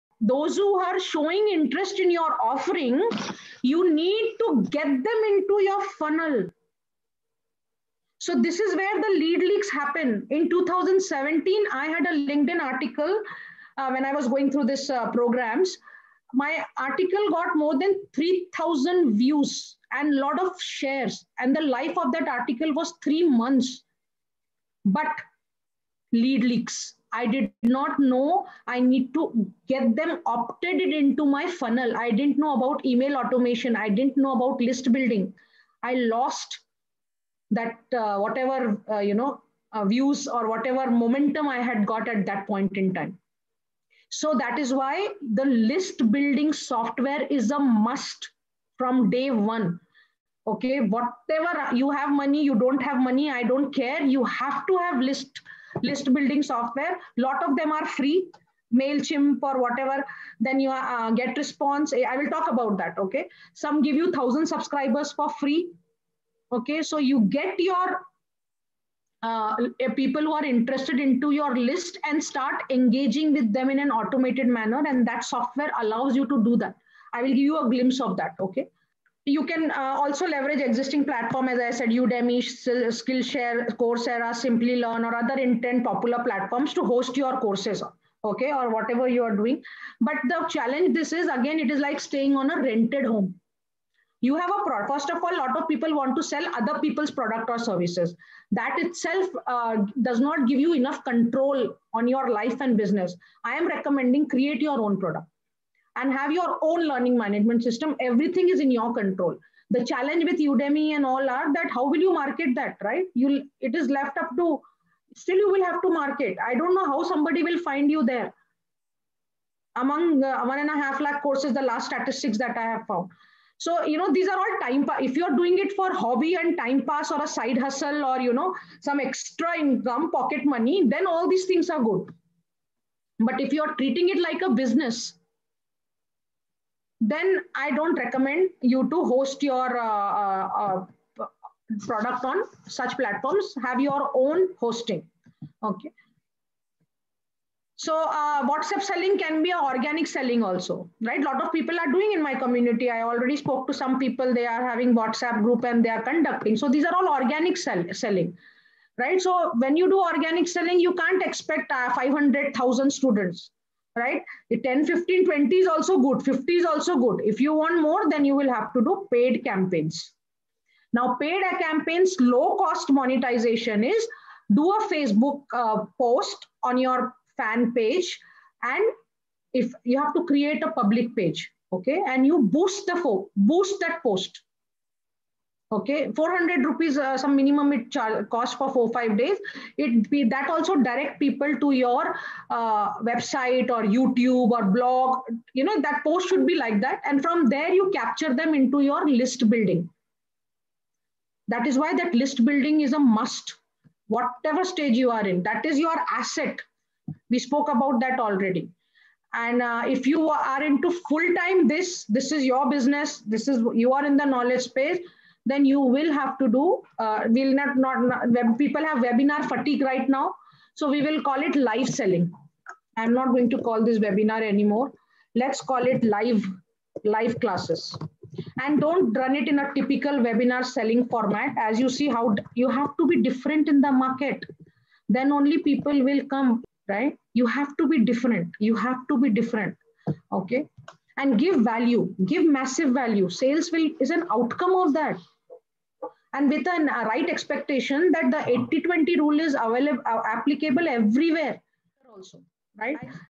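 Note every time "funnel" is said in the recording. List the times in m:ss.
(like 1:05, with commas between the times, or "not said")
0:05, 0:31.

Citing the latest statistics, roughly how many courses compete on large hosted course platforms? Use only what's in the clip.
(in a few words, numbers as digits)
1.5 lakh.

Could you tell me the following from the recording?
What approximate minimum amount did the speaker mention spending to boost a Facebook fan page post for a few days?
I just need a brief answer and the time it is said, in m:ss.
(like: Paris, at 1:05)
400 rupees, at 3:06.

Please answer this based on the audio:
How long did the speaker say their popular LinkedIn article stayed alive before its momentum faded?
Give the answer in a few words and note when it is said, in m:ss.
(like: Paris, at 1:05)
3 months, at 0:23.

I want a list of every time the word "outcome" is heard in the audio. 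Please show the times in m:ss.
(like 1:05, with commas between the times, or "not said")
4:04.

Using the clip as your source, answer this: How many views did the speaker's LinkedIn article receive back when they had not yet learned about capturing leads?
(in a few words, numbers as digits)
more than 3,000.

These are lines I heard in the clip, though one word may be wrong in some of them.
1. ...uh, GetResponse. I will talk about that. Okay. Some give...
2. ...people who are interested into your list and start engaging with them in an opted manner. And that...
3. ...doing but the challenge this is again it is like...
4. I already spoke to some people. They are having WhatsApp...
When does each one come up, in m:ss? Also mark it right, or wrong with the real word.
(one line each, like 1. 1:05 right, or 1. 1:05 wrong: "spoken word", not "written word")
1. 1:00 right
2. 1:09 wrong: "automated", not "opted"
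3. 1:29 right
4. 2:32 right.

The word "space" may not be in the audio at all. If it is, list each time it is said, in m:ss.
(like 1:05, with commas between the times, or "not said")
3:34.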